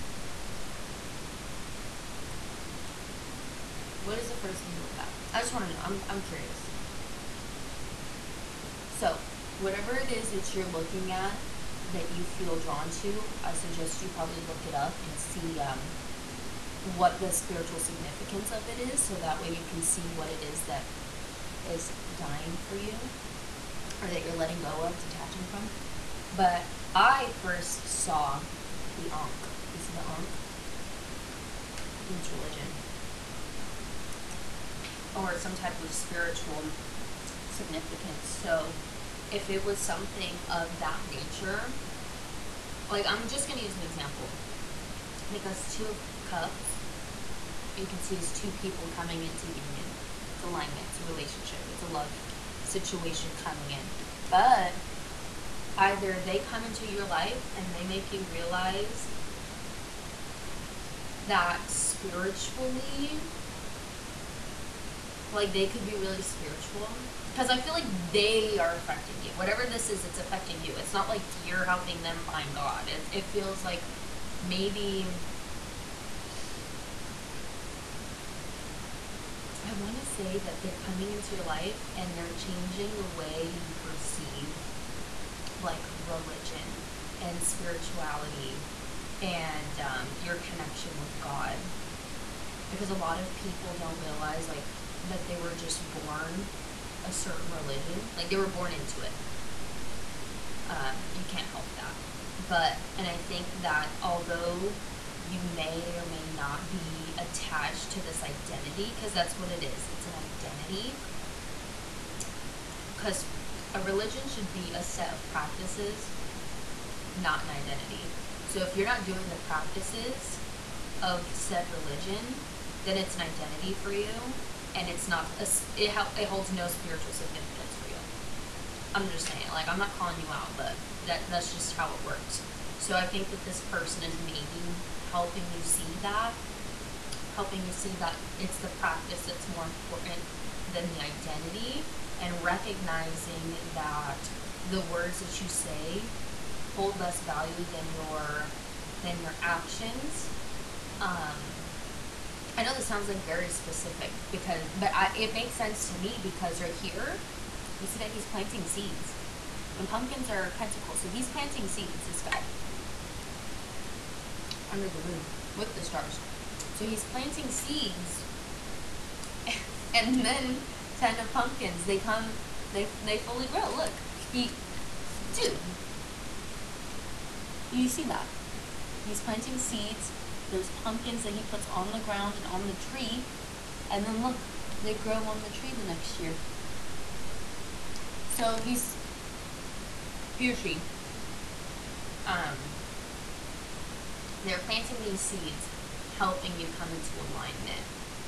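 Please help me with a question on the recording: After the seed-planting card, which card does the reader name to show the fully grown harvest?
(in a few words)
Ten of Pumpkins.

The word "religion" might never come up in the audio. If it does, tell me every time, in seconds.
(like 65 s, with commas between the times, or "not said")
32 s, 86 s, 97 s, 113 s, 121 s.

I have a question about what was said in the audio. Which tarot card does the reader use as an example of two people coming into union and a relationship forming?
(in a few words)
Two of Cups.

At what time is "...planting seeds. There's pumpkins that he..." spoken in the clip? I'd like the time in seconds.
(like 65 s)
179 s.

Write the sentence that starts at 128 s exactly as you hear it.
I'm just saying, like I'm not calling you out, but that that's just how it works.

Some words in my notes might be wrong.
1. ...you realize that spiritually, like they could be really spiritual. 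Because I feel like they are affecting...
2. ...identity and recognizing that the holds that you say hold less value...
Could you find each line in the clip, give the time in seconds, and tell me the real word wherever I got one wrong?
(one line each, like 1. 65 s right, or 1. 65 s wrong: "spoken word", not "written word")
1. 58 s right
2. 140 s wrong: "words", not "holds".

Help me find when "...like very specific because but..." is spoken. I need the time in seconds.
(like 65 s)
153 s.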